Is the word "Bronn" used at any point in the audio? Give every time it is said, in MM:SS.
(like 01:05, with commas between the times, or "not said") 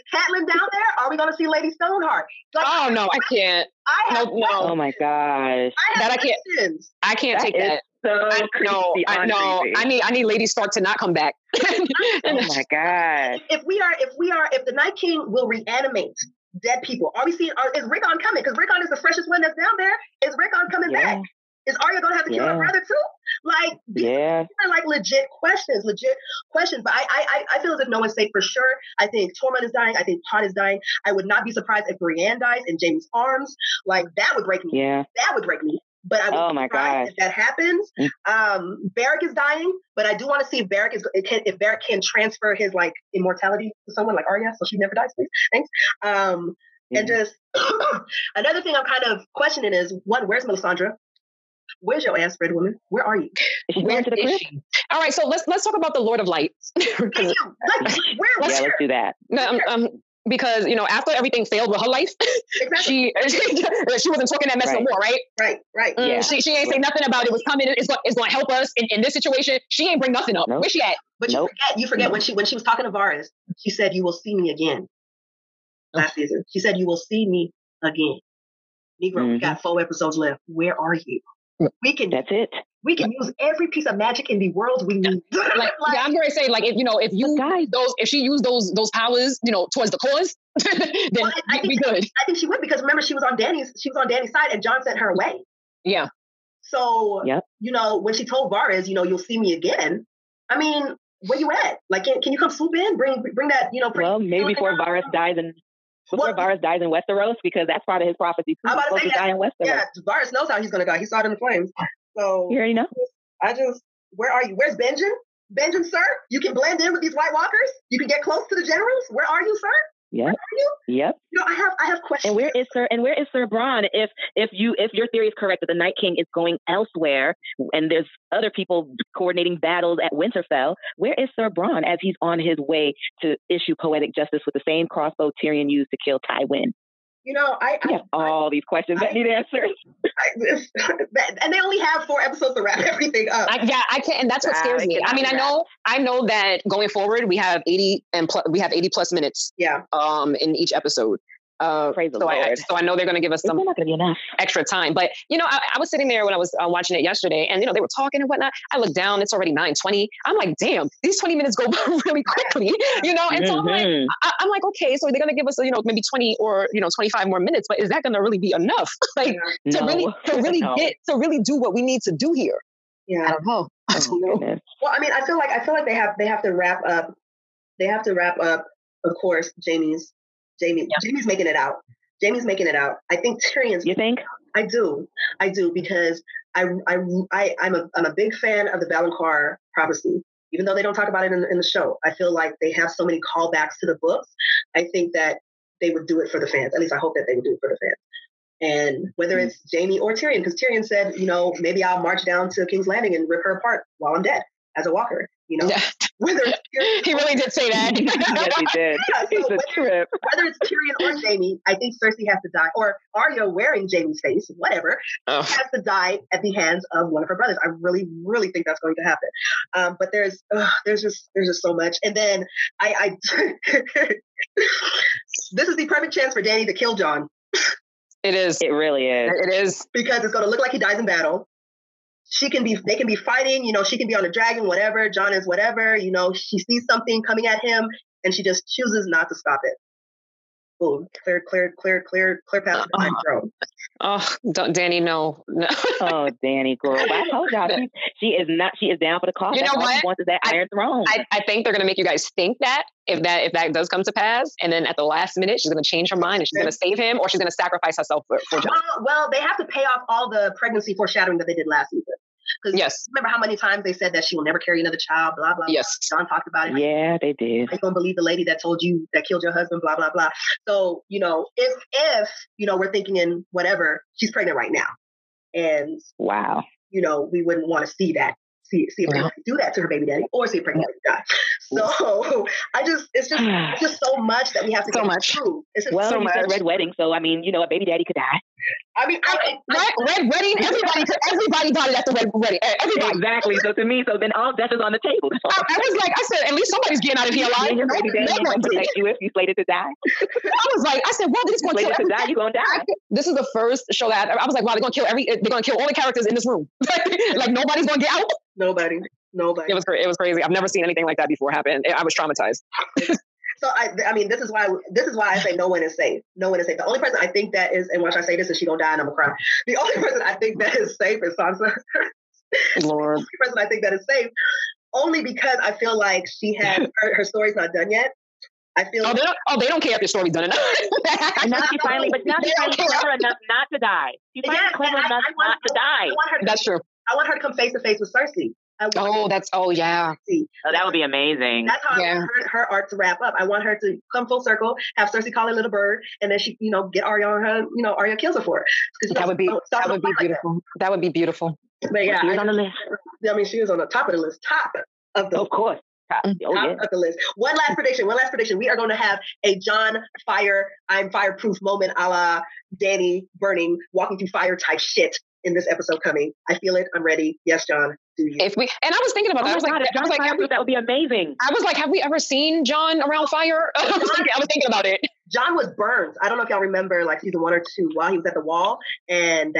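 02:03, 02:11.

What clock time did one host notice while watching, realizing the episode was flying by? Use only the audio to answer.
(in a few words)
9:20.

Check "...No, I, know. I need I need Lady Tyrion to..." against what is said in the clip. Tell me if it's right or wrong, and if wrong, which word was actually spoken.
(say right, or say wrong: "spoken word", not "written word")
wrong: "Stark", not "Tyrion".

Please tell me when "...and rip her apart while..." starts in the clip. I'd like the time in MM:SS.
03:23.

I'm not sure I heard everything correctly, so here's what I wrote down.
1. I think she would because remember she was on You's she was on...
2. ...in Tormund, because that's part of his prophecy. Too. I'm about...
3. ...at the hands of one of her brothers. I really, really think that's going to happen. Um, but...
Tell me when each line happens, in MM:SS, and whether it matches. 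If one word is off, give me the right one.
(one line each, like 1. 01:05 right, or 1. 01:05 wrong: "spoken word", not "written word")
1. 01:32 wrong: "Dany", not "You"
2. 01:46 wrong: "Westeros", not "Tormund"
3. 03:36 right.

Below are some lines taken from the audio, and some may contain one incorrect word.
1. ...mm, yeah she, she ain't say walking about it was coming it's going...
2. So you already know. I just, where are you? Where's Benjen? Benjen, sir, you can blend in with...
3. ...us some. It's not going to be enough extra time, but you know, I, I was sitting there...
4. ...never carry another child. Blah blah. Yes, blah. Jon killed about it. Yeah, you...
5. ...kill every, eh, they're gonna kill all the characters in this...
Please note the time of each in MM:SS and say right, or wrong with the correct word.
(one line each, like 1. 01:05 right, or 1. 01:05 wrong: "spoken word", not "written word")
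1. 01:05 wrong: "nothing", not "walking"
2. 01:52 right
3. 02:33 right
4. 04:24 wrong: "talked", not "killed"
5. 05:04 right.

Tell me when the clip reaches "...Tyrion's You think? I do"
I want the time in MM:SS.
03:03.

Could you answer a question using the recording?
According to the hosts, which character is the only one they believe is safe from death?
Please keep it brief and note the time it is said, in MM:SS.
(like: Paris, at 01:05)
Sansa, at 05:21.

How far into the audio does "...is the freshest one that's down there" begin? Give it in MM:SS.
00:18.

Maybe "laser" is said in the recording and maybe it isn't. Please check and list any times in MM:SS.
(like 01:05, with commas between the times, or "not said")
not said.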